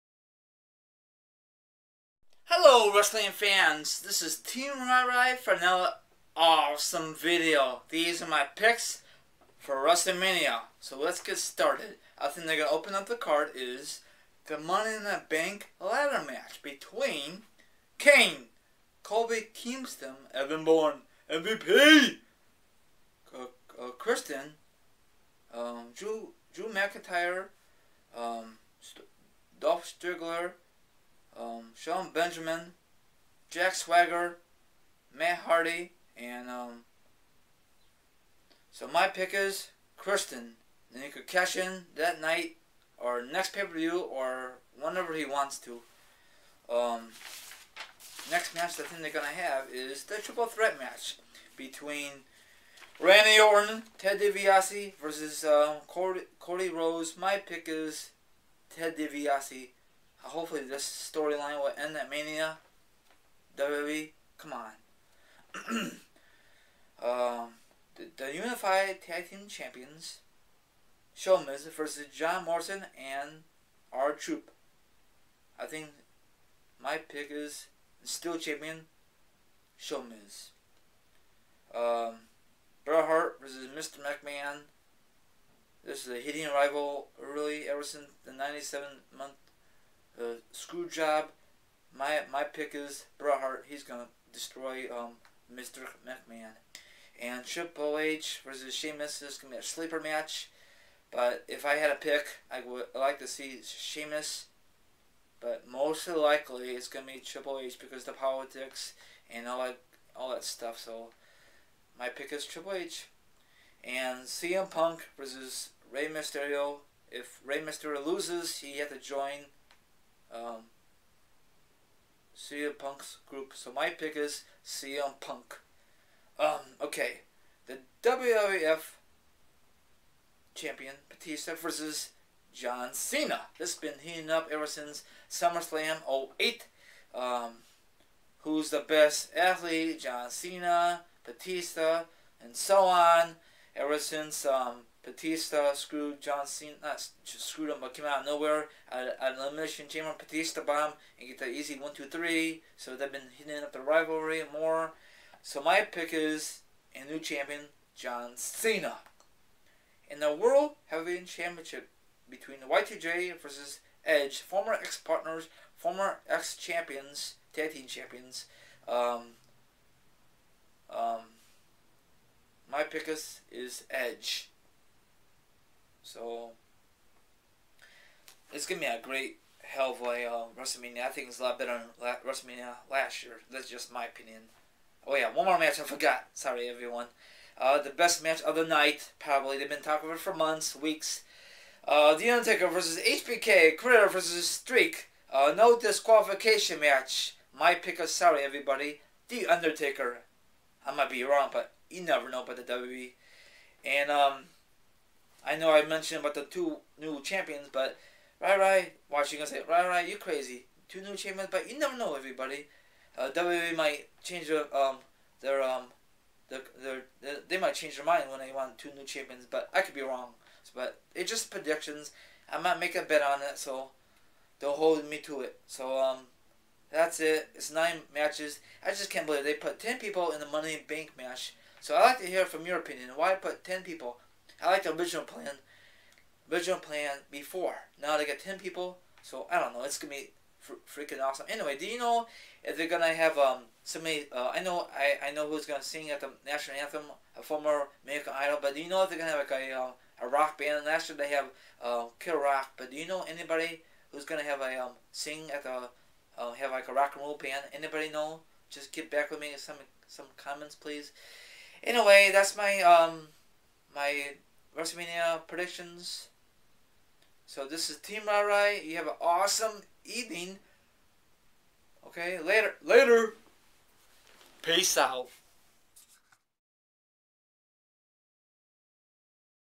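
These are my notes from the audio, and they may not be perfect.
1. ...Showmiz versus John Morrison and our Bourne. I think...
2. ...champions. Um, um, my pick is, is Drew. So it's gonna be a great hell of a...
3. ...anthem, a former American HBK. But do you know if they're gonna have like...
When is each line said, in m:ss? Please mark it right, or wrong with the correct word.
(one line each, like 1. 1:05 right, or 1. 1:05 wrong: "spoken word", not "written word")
1. 1:11 wrong: "Troop", not "Bourne"
2. 2:47 wrong: "Edge", not "Drew"
3. 4:06 wrong: "Idol", not "HBK".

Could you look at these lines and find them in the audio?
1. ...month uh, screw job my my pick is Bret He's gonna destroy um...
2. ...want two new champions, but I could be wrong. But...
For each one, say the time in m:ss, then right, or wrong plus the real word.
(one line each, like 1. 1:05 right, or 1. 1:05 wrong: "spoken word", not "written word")
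1. 1:29 right
2. 3:38 right.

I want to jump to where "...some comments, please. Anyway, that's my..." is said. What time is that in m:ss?
4:20.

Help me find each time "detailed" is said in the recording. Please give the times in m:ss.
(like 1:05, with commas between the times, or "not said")
not said.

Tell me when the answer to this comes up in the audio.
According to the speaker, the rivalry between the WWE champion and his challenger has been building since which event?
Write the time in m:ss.
2:15.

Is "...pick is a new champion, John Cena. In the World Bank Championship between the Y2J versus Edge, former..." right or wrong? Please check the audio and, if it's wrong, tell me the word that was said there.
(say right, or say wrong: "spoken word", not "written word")
wrong: "Heavyweight", not "Bank".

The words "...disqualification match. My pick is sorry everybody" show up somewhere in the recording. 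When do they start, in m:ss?
3:15.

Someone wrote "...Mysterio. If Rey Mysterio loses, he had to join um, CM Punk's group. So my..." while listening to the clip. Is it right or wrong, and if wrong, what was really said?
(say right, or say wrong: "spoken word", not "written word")
right.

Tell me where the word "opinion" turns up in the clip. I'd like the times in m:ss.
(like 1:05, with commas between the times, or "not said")
3:04, 3:52.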